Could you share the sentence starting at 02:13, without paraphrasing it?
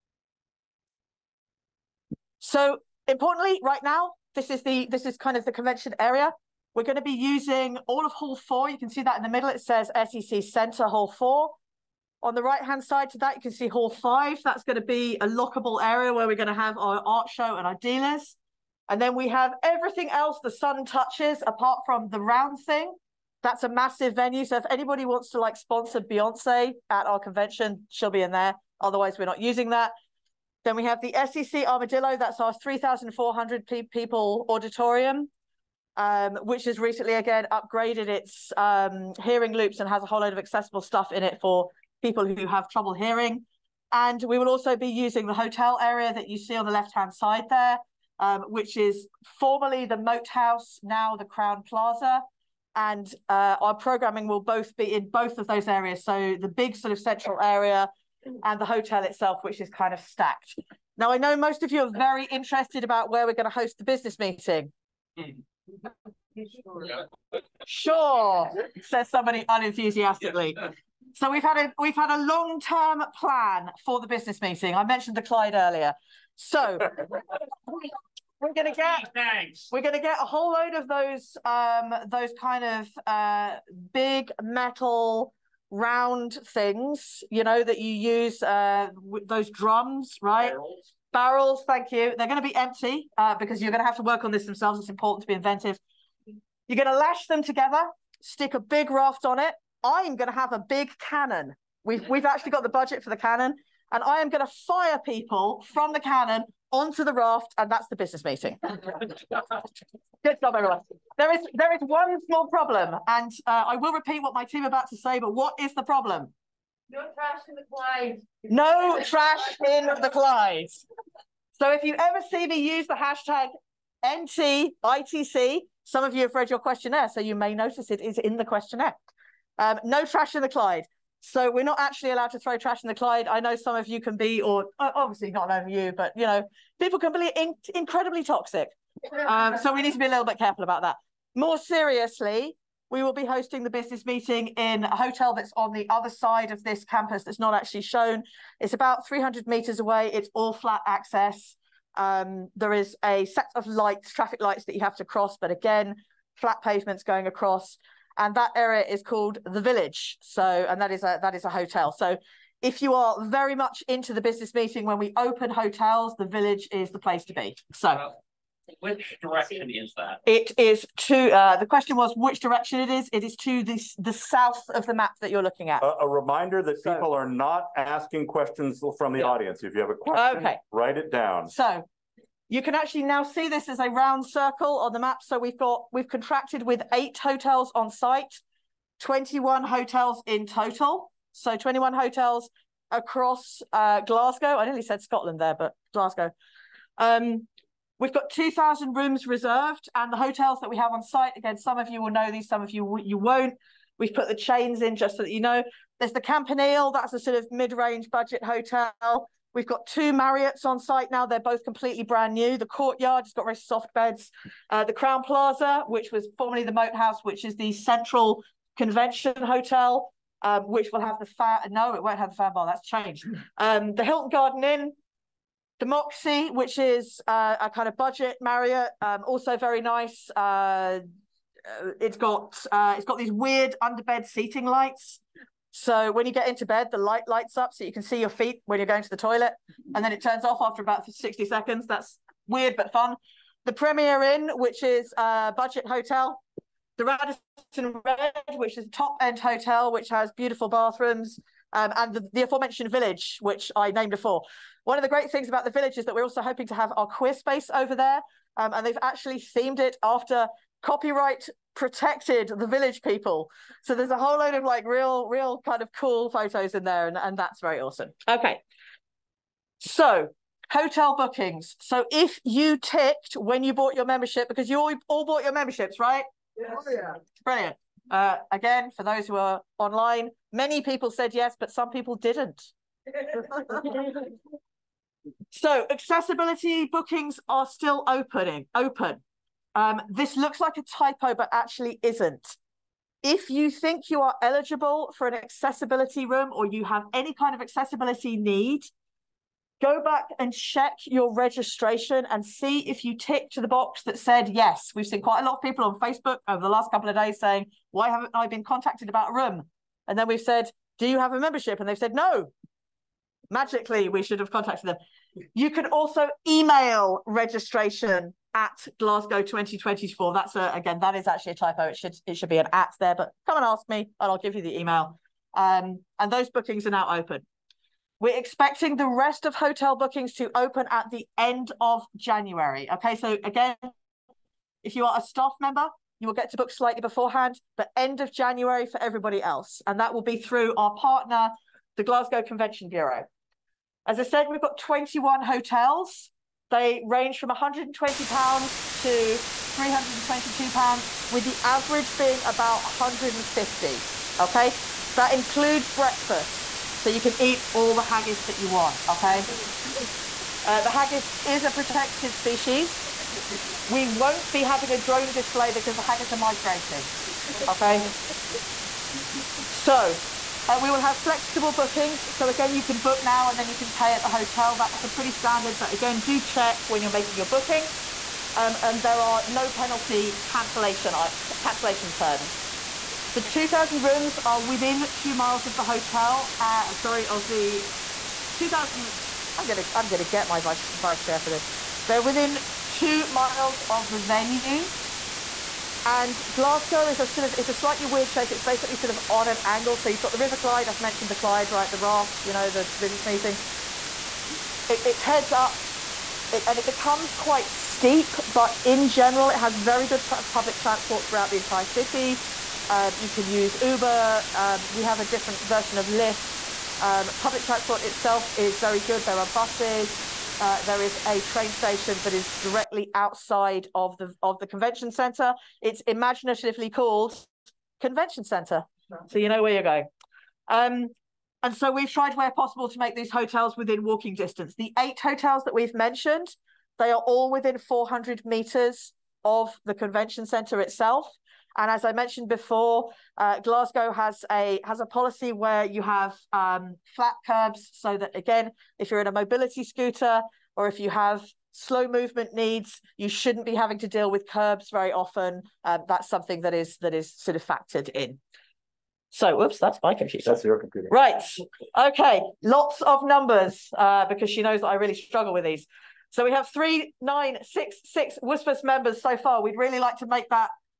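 I know some of you can be, or obviously not over you, but you know, people can be in incredibly toxic.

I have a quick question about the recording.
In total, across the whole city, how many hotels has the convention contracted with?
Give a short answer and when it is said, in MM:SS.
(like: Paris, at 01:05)
21, at 03:09.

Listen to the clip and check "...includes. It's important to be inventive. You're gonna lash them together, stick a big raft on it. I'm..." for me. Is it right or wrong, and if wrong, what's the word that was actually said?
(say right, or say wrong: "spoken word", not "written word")
wrong: "themselves", not "includes".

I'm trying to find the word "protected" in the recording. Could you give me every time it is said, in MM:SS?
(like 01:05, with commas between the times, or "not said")
04:21, 06:01.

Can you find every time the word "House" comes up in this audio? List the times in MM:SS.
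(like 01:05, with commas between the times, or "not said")
00:50, 03:36.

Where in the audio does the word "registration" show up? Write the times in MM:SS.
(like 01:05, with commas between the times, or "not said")
05:01, 05:17.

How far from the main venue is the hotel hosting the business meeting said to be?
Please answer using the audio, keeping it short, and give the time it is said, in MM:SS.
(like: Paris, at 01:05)
300 meters, at 02:29.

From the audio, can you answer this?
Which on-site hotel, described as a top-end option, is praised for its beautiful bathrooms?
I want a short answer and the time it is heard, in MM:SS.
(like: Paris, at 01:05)
Radisson Red, at 04:07.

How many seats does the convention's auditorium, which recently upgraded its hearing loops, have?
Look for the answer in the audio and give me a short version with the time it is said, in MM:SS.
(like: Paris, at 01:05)
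3,400, at 00:32.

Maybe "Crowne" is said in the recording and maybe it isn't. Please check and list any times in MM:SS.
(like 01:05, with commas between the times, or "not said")
00:51, 03:34.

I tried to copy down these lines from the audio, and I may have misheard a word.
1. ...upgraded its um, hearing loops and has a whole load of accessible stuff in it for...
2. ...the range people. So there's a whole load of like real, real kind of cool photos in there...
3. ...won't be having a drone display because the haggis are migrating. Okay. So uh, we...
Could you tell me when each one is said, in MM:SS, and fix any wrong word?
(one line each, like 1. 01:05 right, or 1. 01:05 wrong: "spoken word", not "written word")
1. 00:37 right
2. 04:22 wrong: "village", not "range"
3. 06:04 right.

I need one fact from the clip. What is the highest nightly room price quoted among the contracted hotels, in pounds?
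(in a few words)
322 pounds.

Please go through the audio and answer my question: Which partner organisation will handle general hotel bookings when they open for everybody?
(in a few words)
Glasgow Convention Bureau.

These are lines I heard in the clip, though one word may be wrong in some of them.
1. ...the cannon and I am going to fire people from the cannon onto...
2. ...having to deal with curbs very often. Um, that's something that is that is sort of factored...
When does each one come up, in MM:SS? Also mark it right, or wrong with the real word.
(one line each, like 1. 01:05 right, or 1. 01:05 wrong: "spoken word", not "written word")
1. 01:43 right
2. 07:33 right.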